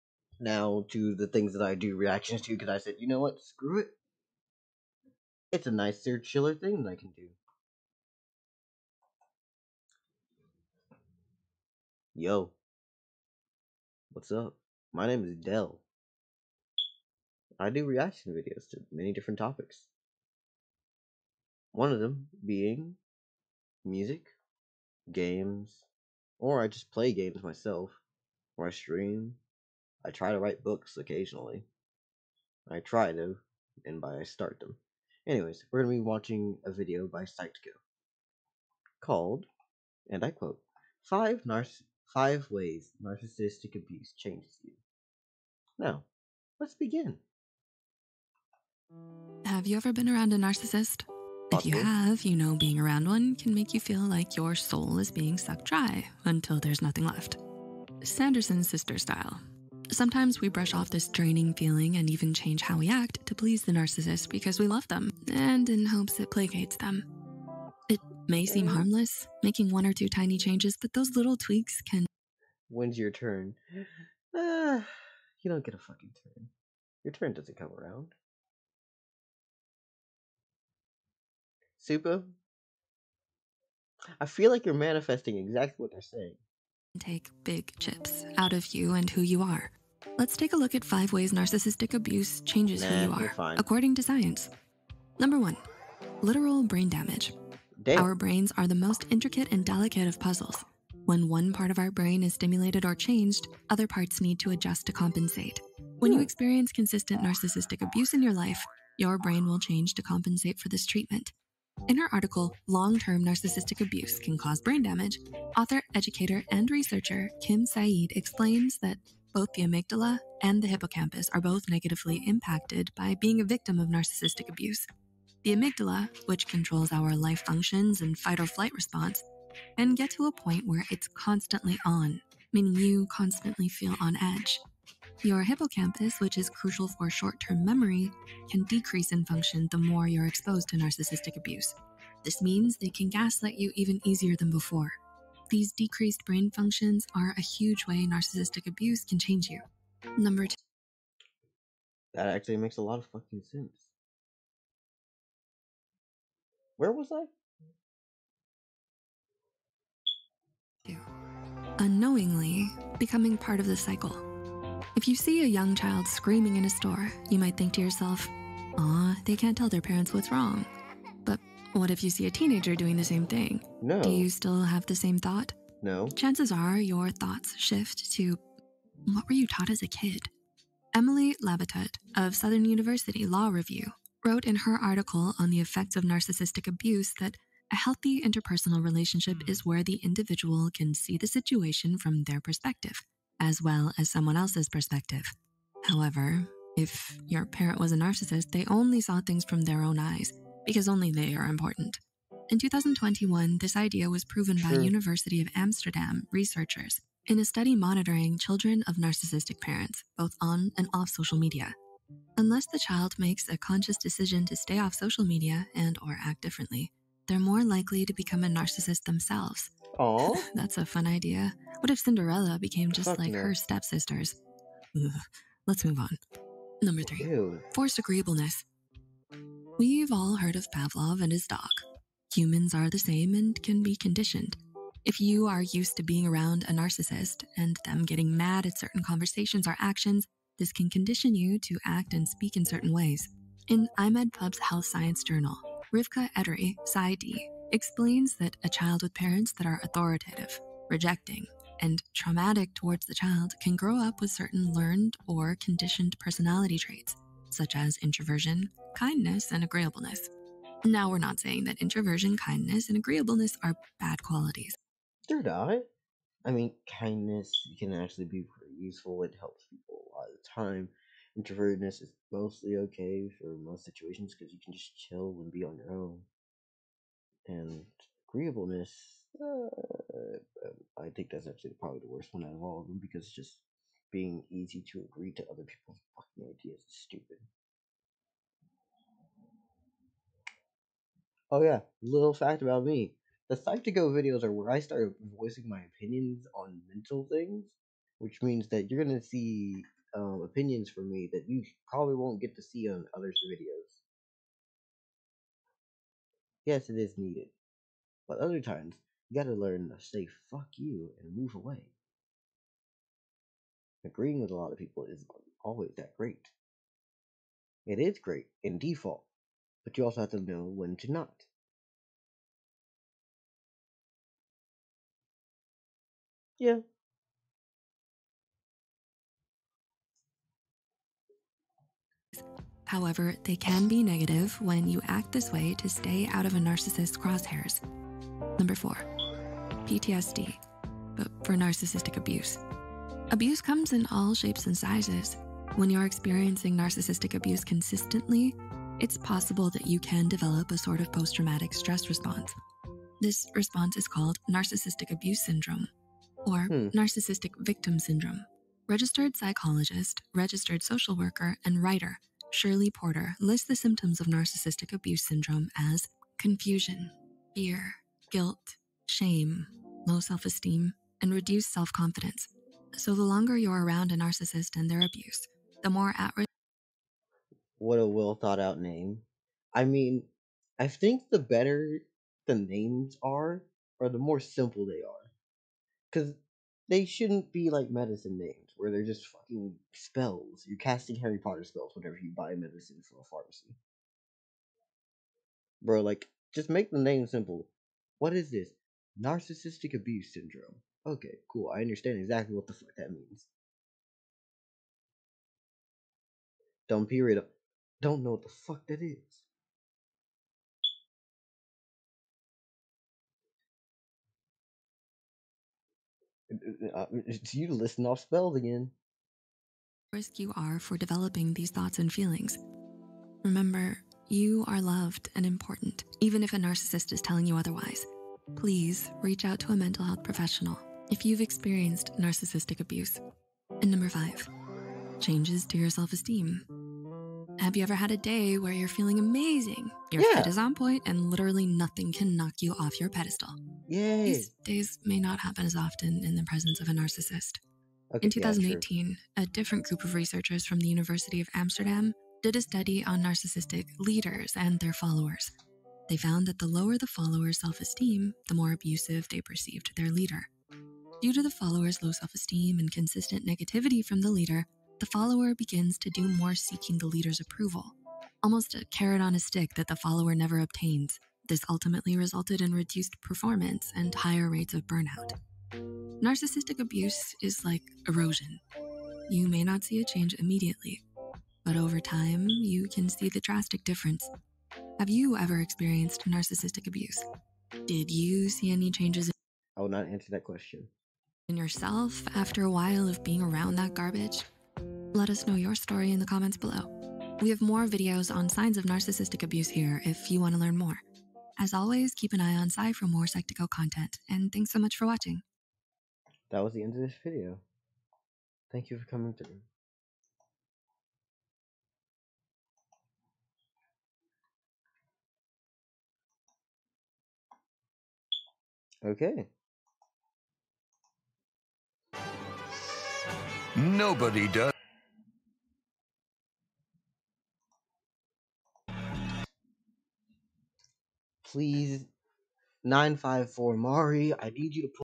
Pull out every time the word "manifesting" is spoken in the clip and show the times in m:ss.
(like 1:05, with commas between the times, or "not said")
1:24.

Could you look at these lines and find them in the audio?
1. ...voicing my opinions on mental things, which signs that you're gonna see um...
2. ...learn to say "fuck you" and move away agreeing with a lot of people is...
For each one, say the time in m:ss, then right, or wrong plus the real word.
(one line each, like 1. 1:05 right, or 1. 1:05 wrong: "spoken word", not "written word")
1. 4:55 wrong: "means", not "signs"
2. 5:09 right.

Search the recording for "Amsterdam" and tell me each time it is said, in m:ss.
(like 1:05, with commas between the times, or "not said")
3:25, 7:31.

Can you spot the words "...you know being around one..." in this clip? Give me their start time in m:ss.
0:52.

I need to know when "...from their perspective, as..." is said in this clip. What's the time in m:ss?
3:11.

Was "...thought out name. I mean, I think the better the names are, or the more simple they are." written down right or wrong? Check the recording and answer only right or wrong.
right.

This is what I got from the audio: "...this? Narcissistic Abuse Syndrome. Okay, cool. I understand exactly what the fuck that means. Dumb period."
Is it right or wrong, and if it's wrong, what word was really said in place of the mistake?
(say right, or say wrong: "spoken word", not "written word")
right.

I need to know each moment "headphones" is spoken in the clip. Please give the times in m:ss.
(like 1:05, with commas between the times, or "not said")
not said.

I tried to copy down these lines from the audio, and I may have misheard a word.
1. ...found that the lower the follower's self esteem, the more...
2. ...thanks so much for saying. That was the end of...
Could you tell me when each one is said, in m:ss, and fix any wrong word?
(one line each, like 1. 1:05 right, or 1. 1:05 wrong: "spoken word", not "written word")
1. 7:36 right
2. 8:24 wrong: "watching", not "saying".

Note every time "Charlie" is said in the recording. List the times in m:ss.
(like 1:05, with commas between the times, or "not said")
not said.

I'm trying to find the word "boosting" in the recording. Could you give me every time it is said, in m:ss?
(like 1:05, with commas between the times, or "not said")
not said.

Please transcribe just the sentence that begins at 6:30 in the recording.
You're casting Harry Potter spells whenever you buy medicine from a pharmacy.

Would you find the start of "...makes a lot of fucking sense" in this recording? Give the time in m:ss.
2:32.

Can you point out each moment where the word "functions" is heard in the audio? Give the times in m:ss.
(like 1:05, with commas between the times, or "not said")
2:07, 2:19, 2:26.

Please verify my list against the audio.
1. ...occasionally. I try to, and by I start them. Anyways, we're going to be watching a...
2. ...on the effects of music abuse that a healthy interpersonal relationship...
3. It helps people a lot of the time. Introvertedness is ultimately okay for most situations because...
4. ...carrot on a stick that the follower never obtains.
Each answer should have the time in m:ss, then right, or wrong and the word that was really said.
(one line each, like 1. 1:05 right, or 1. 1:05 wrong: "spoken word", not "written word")
1. 0:30 right
2. 3:05 wrong: "narcissistic", not "music"
3. 4:29 wrong: "mostly", not "ultimately"
4. 7:48 right.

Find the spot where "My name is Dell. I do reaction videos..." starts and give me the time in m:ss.
0:14.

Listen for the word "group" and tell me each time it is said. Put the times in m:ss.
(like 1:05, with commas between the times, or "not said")
7:29.